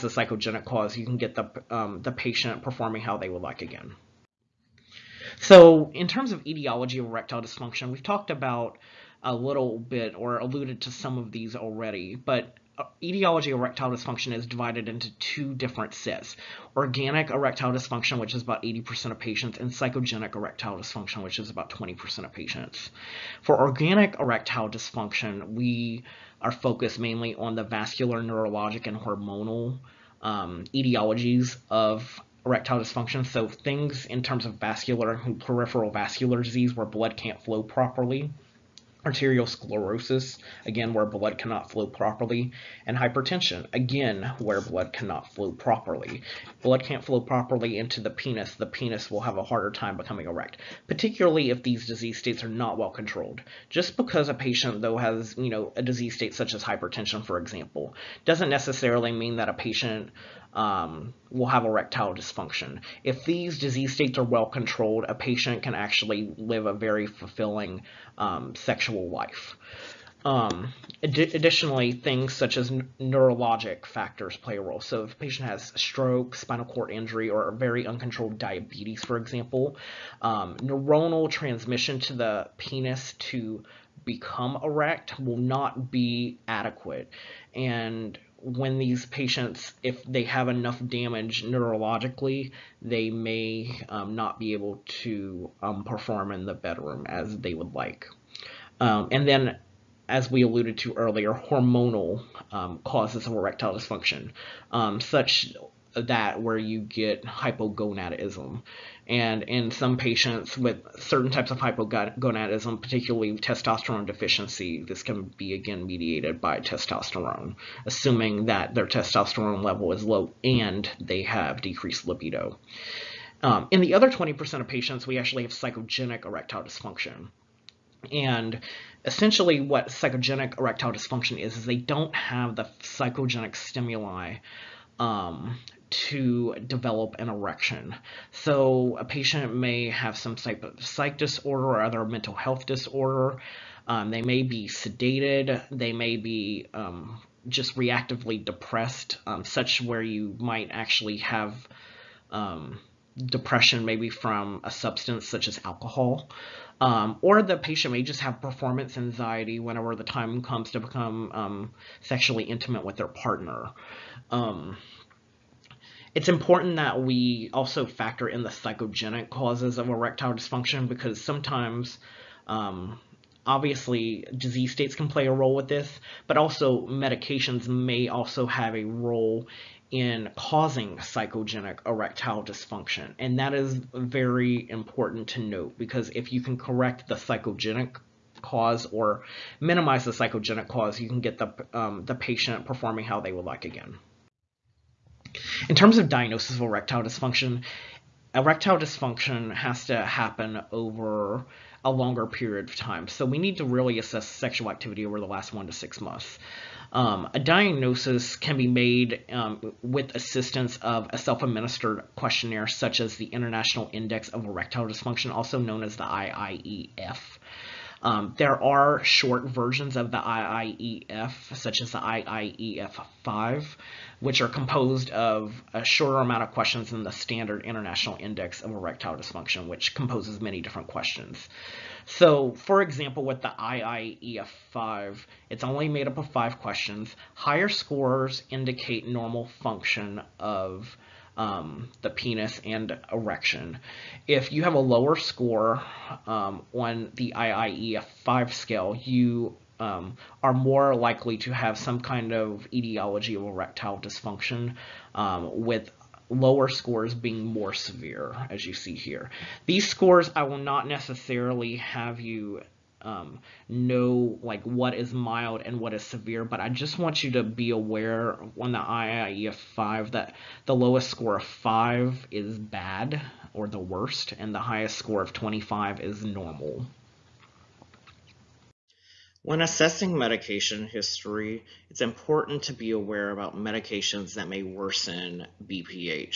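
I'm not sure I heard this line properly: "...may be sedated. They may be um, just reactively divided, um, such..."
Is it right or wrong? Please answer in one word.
wrong.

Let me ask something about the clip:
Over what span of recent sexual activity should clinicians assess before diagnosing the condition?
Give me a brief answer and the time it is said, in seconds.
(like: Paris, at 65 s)
1 to 6 months, at 205 s.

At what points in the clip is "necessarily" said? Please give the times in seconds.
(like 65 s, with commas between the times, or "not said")
58 s, 260 s.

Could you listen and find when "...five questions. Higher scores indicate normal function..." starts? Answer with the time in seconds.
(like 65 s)
236 s.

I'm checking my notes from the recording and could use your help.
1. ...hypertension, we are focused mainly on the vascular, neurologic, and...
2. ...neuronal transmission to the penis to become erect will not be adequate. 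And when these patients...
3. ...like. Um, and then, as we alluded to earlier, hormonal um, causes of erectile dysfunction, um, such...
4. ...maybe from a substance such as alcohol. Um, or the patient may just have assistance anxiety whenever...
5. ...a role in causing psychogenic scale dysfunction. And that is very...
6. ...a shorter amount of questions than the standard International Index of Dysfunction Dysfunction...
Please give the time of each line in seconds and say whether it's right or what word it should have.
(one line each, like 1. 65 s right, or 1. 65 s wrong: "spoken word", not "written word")
1. 24 s wrong: "dysfunction", not "hypertension"
2. 80 s right
3. 97 s right
4. 153 s wrong: "performance", not "assistance"
5. 178 s wrong: "erectile", not "scale"
6. 225 s wrong: "Erectile", not "Dysfunction".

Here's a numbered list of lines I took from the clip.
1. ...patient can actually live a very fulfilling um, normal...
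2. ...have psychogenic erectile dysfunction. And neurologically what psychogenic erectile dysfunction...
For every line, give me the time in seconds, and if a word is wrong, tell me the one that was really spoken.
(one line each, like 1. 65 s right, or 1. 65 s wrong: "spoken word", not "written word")
1. 65 s wrong: "sexual", not "normal"
2. 125 s wrong: "essentially", not "neurologically".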